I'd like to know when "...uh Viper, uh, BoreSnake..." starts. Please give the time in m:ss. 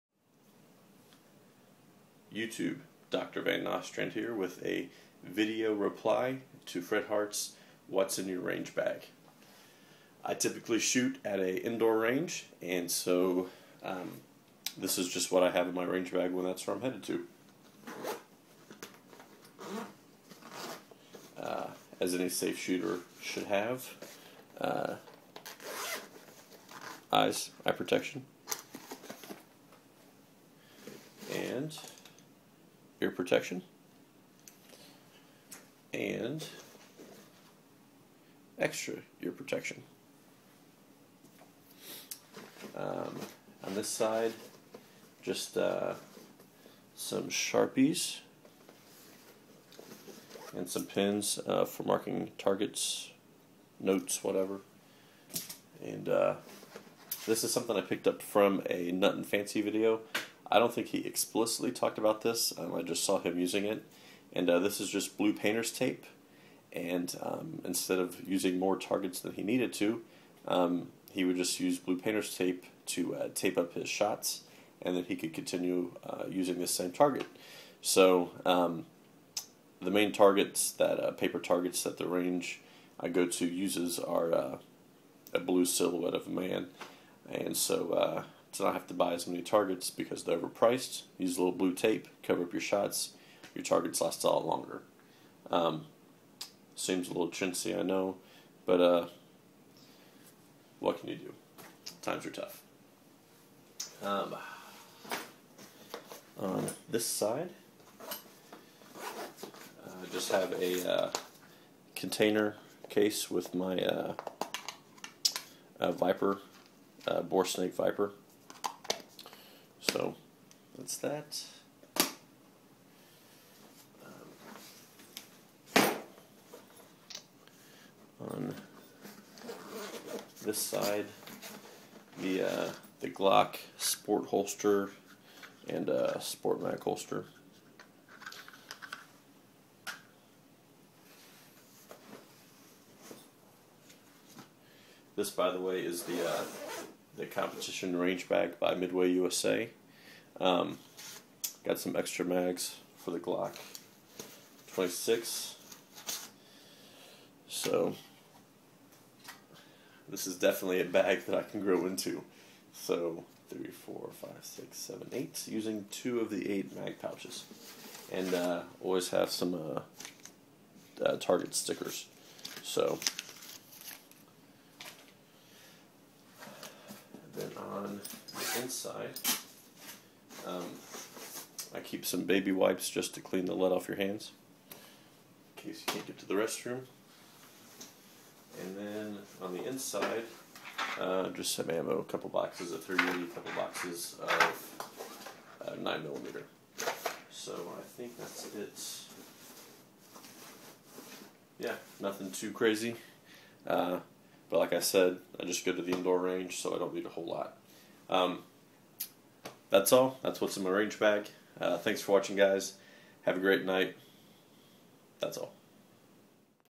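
1:55.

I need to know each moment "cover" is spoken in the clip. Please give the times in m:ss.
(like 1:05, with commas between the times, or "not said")
1:32.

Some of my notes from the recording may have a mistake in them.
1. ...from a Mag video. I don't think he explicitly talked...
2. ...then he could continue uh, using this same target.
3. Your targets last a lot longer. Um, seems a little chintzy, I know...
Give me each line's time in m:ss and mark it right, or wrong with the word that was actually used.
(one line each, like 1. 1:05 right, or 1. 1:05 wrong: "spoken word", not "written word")
1. 0:58 wrong: "Nutnfancy", not "Mag"
2. 1:14 right
3. 1:33 right.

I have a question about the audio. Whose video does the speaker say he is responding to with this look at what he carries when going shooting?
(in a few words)
Fred Hart.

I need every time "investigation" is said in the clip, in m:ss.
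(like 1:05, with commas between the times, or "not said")
not said.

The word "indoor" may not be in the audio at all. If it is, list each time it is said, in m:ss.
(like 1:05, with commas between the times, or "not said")
0:11, 3:25.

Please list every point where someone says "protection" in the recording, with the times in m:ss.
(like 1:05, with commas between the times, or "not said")
0:27, 0:33, 0:39.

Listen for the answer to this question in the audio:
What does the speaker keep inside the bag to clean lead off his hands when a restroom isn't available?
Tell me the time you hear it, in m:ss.
3:02.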